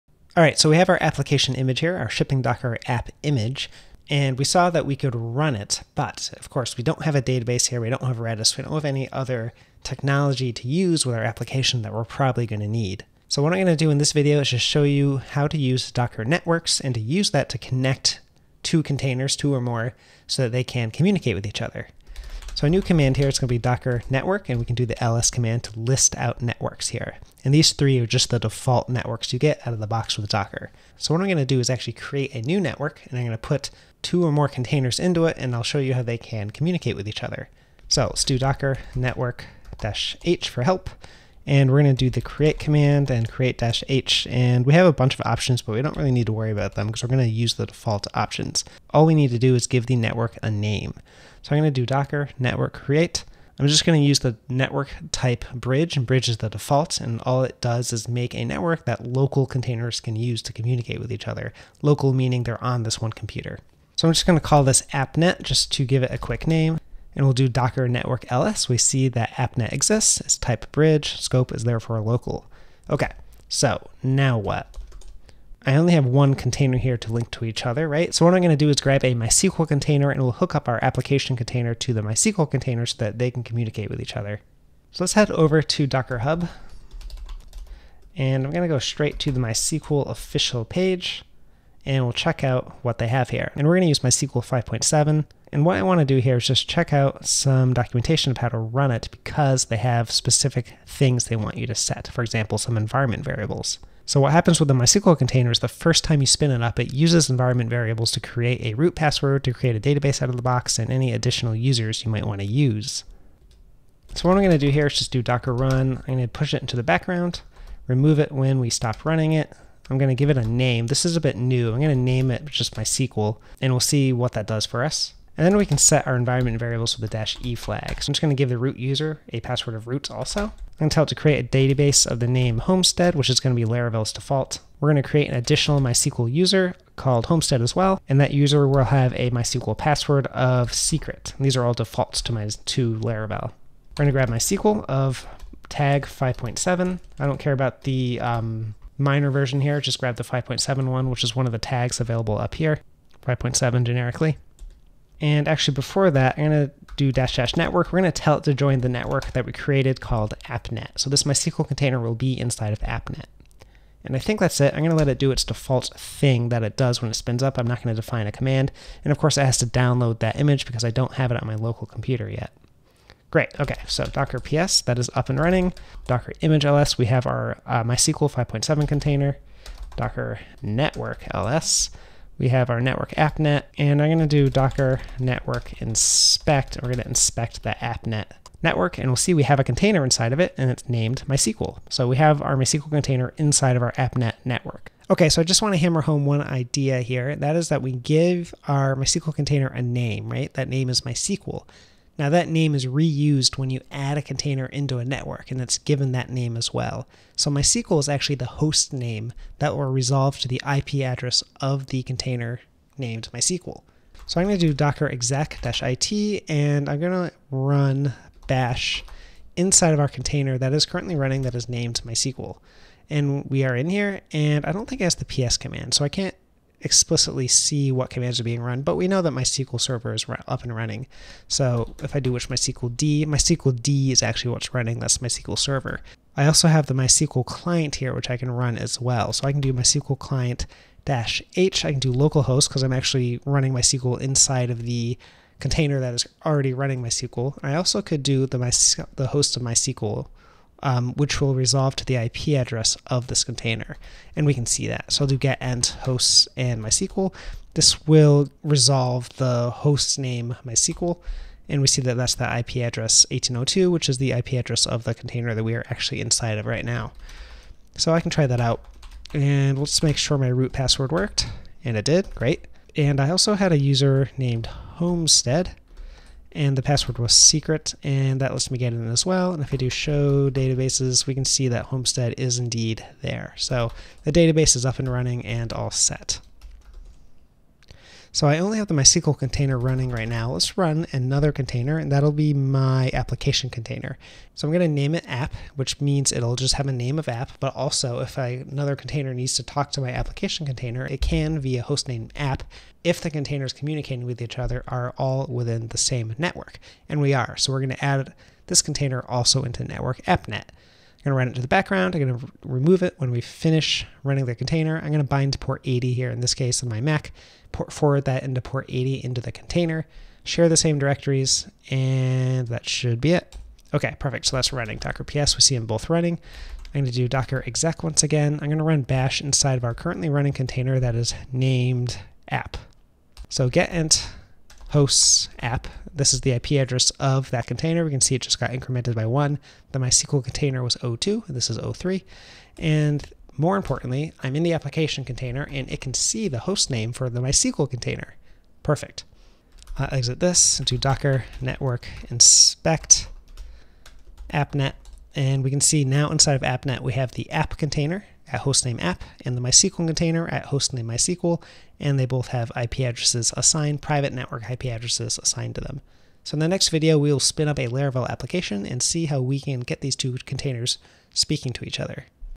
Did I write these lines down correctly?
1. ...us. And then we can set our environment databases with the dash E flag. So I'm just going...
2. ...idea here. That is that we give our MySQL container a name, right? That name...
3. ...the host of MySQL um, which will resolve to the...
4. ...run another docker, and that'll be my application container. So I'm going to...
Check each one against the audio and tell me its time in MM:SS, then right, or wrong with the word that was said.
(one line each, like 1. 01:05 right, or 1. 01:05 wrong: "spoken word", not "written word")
1. 02:04 wrong: "variables", not "databases"
2. 03:16 right
3. 04:09 right
4. 04:50 wrong: "container", not "docker".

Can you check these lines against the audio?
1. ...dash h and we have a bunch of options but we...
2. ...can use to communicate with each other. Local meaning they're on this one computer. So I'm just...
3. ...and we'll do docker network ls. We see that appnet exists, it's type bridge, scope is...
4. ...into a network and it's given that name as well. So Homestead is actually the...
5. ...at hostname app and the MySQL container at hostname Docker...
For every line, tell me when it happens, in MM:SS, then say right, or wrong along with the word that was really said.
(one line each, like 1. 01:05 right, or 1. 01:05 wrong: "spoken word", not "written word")
1. 00:43 right
2. 00:59 right
3. 01:07 right
4. 03:24 wrong: "MySQL", not "Homestead"
5. 05:58 wrong: "MySQL", not "Docker".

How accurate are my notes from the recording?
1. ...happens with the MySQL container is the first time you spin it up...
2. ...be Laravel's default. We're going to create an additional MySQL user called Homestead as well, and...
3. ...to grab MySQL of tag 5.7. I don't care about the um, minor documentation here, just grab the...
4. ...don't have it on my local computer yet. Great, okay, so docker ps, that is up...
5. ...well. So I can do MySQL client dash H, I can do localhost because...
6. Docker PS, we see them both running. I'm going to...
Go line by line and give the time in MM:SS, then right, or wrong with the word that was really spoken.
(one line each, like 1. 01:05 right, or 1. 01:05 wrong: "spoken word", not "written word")
1. 01:44 right
2. 02:13 right
3. 02:24 wrong: "version", not "documentation"
4. 02:50 right
5. 03:58 right
6. 05:24 right.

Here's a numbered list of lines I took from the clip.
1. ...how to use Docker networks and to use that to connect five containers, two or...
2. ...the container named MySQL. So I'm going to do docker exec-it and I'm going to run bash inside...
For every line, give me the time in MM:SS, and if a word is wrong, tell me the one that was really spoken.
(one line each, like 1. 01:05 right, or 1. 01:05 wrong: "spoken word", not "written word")
1. 00:15 wrong: "two", not "five"
2. 03:31 right.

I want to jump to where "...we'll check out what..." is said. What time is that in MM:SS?
01:32.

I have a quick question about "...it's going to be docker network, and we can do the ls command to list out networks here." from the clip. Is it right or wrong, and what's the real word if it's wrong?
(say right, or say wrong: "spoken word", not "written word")
right.